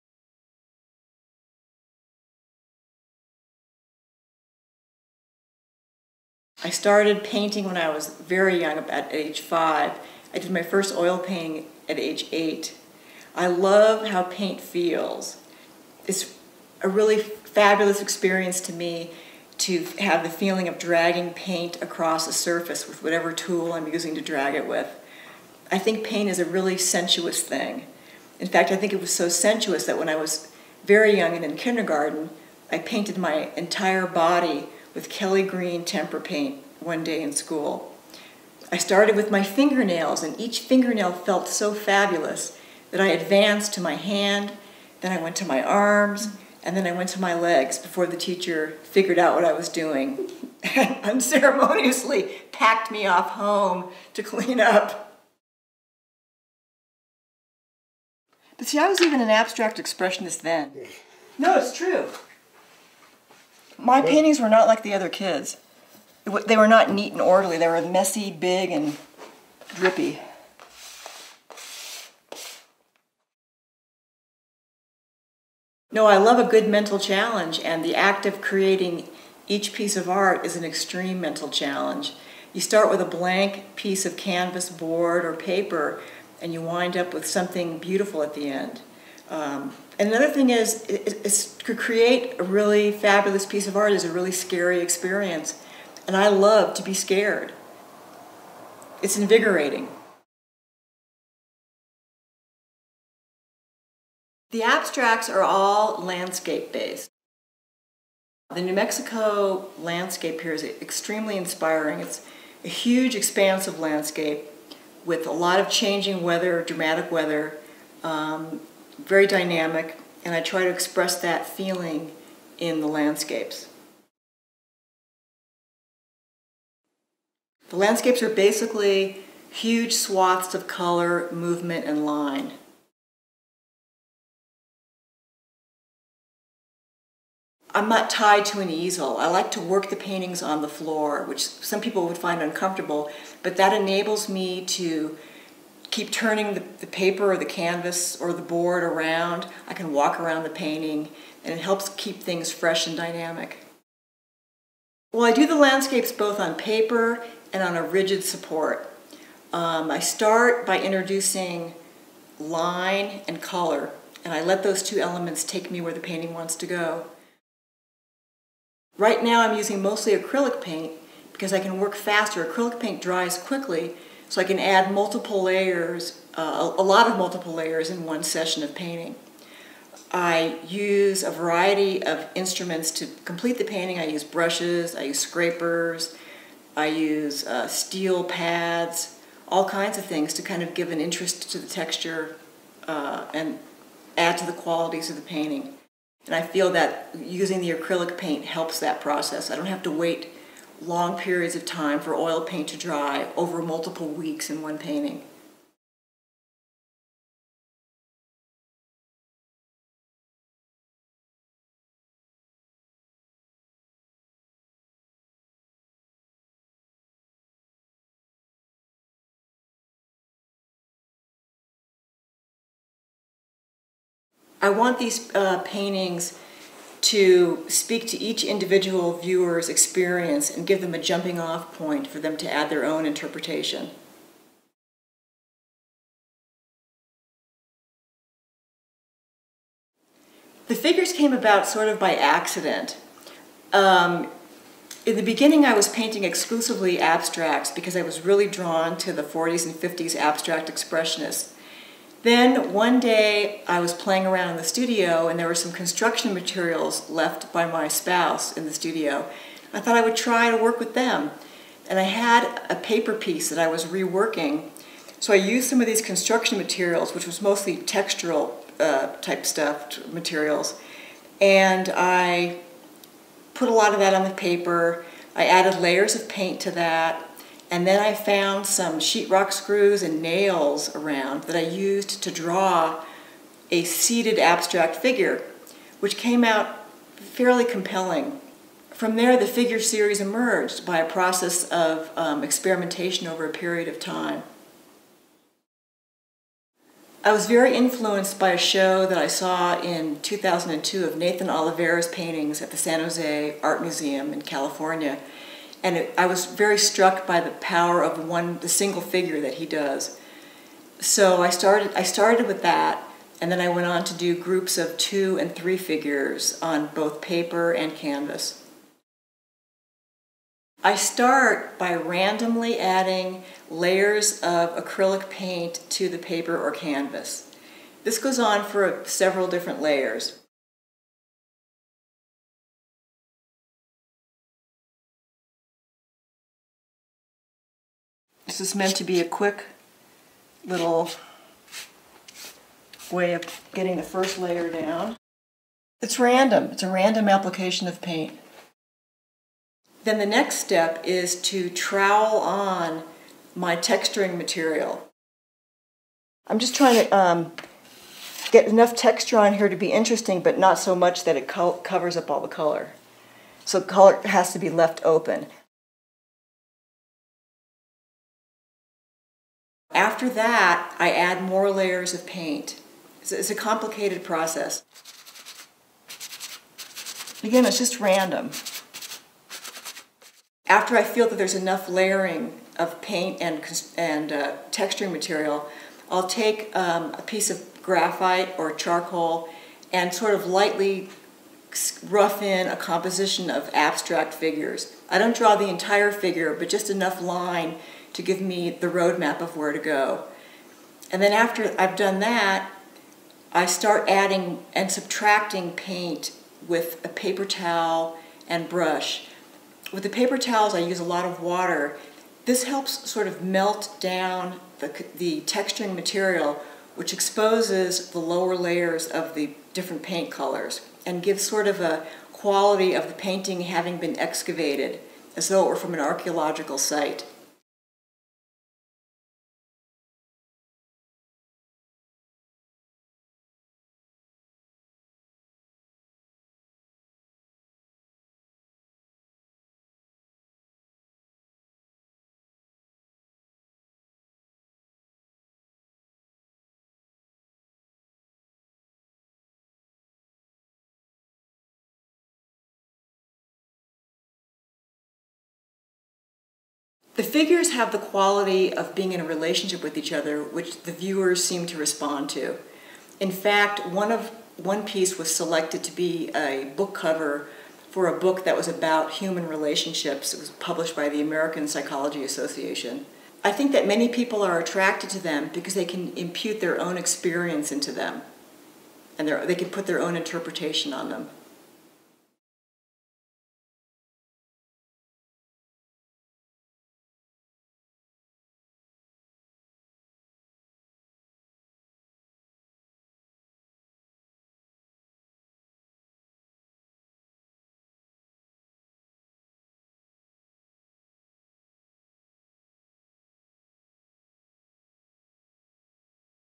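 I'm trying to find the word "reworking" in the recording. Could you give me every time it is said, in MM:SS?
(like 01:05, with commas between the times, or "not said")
04:23.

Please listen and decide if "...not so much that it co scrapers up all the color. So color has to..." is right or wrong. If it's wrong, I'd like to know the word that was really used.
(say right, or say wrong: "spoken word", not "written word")
wrong: "covers", not "scrapers".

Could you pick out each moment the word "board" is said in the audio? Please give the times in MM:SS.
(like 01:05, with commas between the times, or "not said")
01:24, 02:28.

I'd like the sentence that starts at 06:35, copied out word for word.
I don't draw the entire figure, but just enough line to give me the roadmap of where to go.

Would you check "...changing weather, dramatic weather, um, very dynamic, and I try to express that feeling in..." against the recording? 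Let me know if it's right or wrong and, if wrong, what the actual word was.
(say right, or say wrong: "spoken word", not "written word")
right.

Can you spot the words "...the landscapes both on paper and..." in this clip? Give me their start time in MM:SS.
02:35.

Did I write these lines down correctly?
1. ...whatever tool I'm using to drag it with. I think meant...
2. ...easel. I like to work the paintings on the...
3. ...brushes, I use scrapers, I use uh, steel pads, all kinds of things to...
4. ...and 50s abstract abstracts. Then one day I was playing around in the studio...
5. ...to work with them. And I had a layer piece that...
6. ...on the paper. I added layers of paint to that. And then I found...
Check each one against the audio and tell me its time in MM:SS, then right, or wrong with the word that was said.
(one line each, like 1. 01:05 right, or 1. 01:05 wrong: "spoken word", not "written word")
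1. 00:23 wrong: "paint", not "meant"
2. 02:18 right
3. 03:04 right
4. 04:09 wrong: "expressionists", not "abstracts"
5. 04:20 wrong: "paper", not "layer"
6. 04:34 right.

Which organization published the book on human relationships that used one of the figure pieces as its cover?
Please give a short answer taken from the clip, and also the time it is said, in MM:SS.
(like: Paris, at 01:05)
American Psychology Association, at 07:51.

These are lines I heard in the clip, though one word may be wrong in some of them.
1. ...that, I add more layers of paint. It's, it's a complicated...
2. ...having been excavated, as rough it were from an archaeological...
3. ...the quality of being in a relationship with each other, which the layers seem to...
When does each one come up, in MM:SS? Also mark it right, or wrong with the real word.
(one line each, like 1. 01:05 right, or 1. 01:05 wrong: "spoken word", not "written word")
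1. 06:10 right
2. 07:03 wrong: "though", not "rough"
3. 07:37 wrong: "viewers", not "layers".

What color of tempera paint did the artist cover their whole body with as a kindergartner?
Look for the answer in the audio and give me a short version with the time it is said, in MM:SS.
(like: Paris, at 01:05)
Kelly Green, at 00:35.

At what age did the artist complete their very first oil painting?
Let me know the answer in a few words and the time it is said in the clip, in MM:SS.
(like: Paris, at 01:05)
8, at 00:11.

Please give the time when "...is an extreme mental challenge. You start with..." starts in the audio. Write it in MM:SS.
01:20.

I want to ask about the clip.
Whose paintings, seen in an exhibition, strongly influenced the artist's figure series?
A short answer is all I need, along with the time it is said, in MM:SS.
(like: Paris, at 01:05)
Nathan Oliveira, at 05:01.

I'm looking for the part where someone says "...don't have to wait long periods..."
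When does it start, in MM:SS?
03:19.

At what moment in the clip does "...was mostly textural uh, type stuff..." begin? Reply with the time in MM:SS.
04:27.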